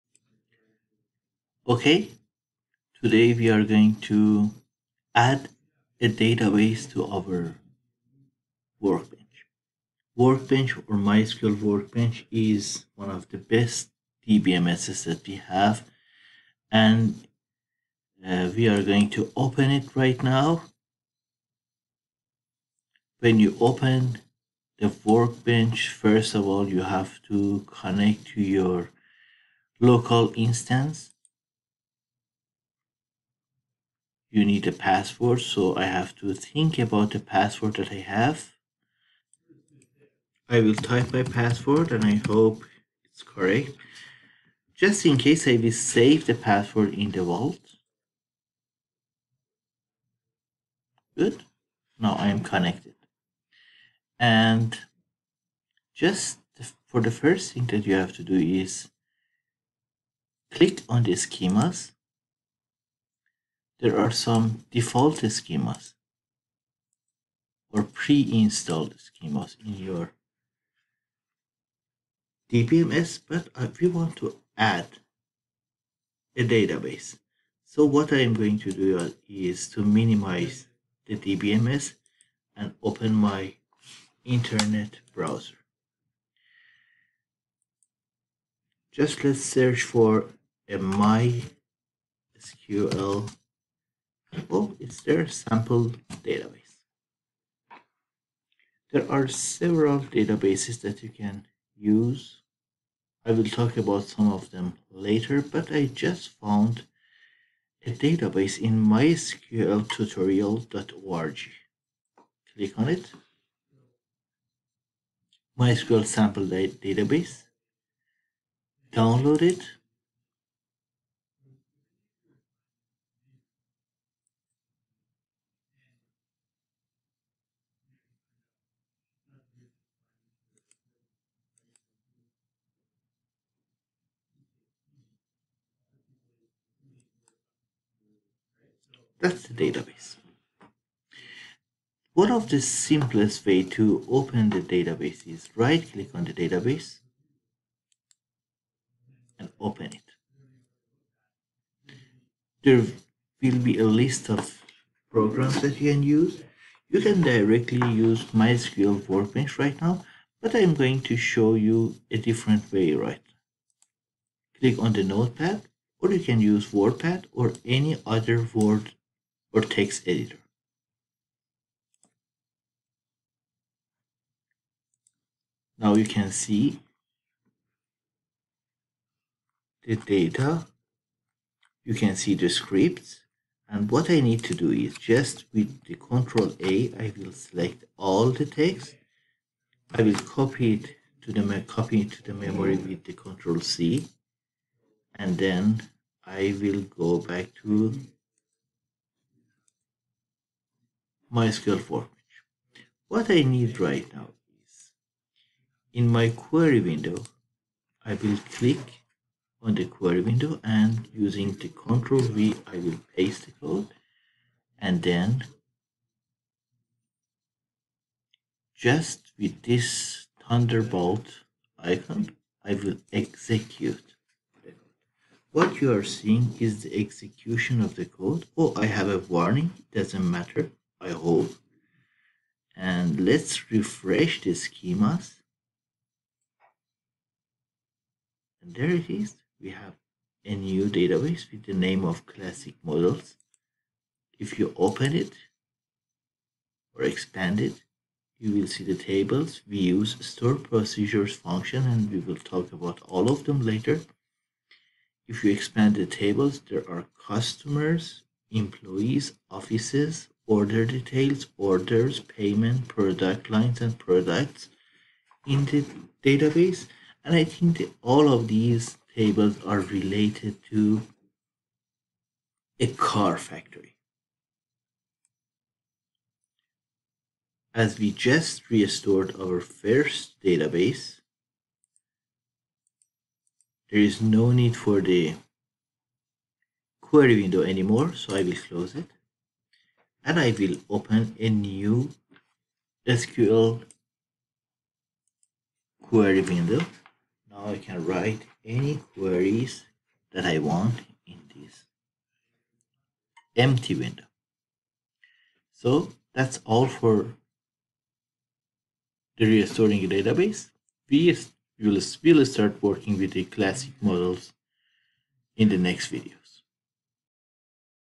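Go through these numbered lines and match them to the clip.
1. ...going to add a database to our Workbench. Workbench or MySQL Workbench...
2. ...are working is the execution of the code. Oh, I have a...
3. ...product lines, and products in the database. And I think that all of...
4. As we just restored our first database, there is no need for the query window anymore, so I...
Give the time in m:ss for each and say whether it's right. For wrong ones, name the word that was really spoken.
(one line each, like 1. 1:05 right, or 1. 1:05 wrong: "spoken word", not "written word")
1. 0:03 right
2. 3:45 wrong: "seeing", not "working"
3. 4:22 right
4. 4:37 right.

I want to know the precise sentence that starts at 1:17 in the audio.
So what I am going to do uh, is to minimize the DBMS and open my internet browser.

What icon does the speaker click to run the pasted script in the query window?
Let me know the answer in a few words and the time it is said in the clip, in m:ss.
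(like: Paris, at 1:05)
Thunderbolt icon, at 3:40.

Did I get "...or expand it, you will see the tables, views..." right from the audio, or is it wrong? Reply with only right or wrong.
right.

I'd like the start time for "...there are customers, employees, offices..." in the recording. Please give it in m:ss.
4:16.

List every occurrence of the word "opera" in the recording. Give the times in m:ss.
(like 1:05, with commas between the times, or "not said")
not said.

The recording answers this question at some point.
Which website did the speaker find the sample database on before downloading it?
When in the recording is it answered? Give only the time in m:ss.
1:48.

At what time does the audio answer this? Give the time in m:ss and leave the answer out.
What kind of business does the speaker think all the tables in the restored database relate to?
4:32.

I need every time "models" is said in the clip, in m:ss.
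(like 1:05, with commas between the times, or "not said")
4:02, 5:14.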